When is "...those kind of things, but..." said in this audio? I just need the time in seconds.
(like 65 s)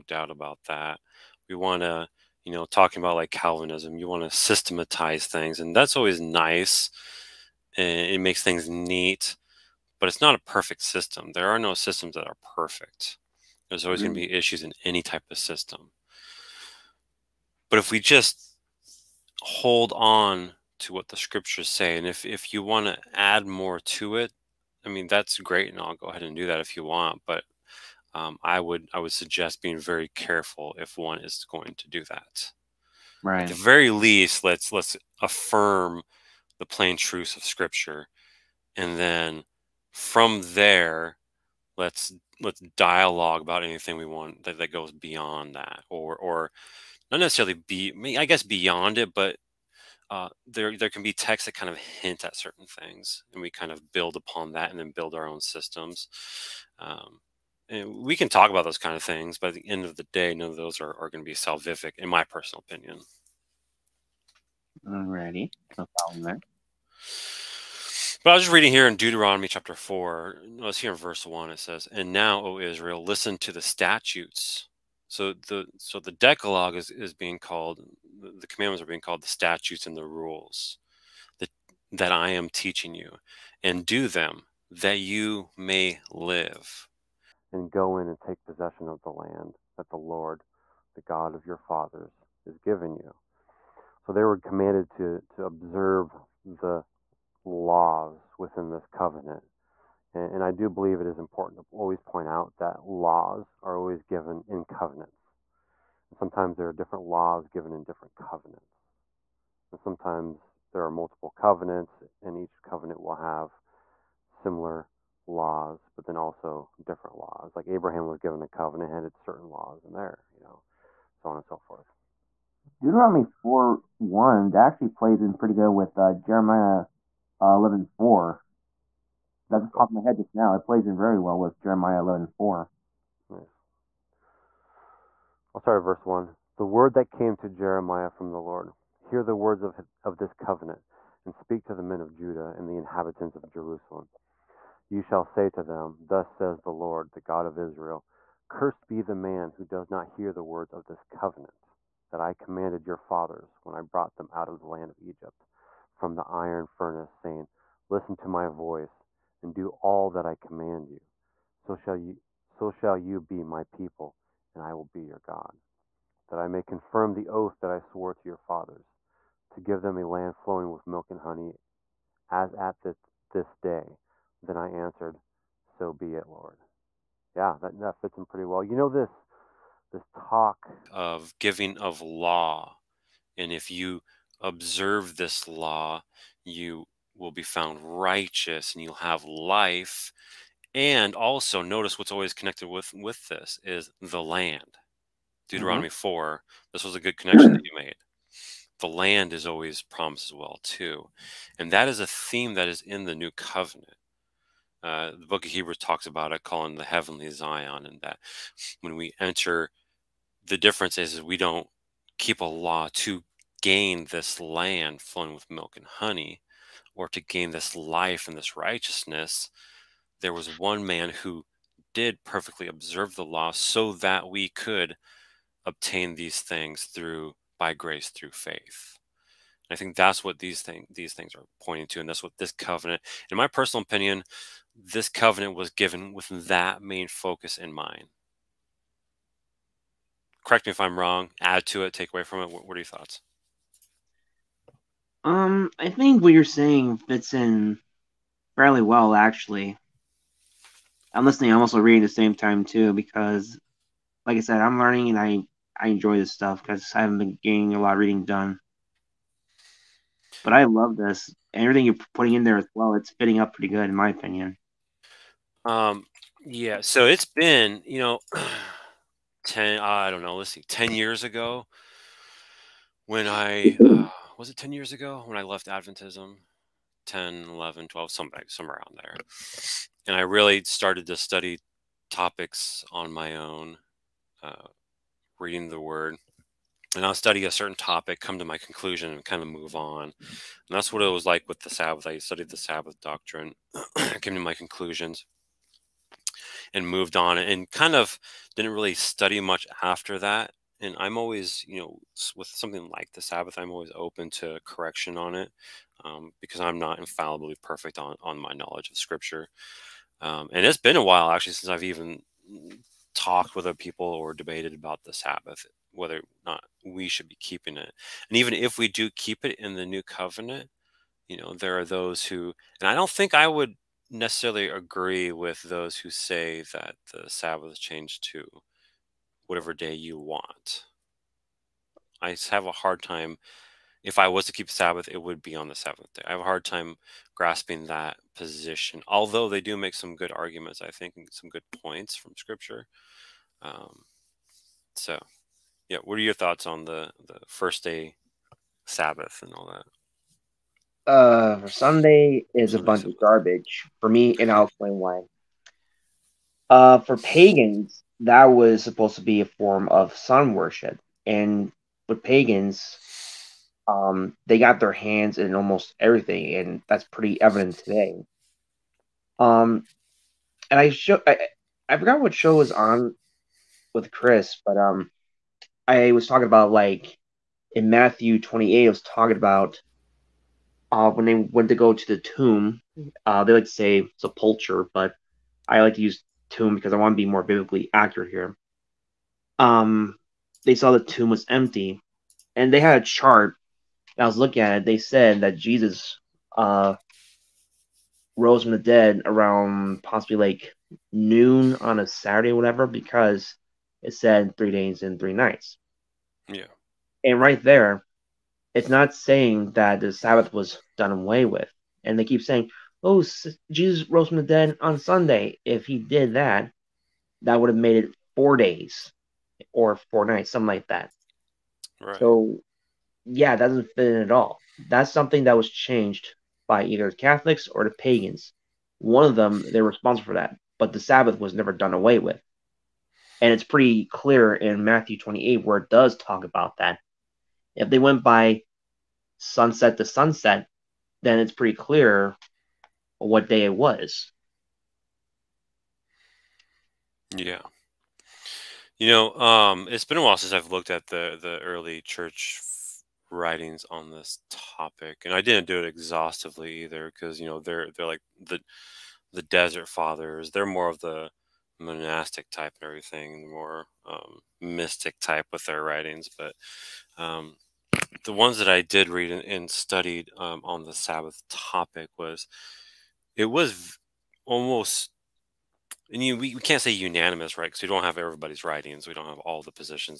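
58 s.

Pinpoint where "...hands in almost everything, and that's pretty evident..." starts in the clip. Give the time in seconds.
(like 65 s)
364 s.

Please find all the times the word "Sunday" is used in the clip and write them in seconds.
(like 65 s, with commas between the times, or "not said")
351 s, 414 s.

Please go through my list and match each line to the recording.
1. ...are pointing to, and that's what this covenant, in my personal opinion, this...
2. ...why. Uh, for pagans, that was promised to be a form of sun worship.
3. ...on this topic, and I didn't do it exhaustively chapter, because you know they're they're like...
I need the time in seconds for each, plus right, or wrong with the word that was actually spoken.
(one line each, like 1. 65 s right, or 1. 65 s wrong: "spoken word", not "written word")
1. 231 s right
2. 354 s wrong: "supposed", not "promised"
3. 453 s wrong: "either", not "chapter".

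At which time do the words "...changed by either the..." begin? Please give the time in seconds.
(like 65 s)
425 s.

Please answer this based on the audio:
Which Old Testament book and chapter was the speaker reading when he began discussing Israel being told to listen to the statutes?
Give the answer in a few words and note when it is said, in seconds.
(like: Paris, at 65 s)
Deuteronomy chapter 4, at 68 s.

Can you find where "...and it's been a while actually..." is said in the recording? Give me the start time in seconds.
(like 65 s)
310 s.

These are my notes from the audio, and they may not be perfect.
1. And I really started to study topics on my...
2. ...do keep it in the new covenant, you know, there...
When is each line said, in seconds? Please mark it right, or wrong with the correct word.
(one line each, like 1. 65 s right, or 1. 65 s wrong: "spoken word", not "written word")
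1. 280 s right
2. 318 s right.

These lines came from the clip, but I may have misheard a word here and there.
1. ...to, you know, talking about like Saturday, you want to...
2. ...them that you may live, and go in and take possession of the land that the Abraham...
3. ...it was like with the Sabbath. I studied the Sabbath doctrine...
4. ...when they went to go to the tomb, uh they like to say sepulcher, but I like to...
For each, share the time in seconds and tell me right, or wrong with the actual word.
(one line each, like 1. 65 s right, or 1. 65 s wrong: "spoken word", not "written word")
1. 1 s wrong: "Calvinism", not "Saturday"
2. 84 s wrong: "Lord", not "Abraham"
3. 291 s right
4. 381 s right.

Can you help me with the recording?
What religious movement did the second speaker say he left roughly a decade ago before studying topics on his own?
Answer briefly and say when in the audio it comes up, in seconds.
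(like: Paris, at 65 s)
Adventism, at 275 s.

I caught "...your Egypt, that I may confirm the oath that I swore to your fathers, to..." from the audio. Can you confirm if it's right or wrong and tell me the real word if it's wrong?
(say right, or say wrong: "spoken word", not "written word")
wrong: "God", not "Egypt".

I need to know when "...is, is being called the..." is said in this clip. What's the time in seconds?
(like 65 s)
76 s.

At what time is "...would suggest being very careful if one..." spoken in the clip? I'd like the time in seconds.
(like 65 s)
28 s.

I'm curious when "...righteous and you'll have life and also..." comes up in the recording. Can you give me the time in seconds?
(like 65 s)
187 s.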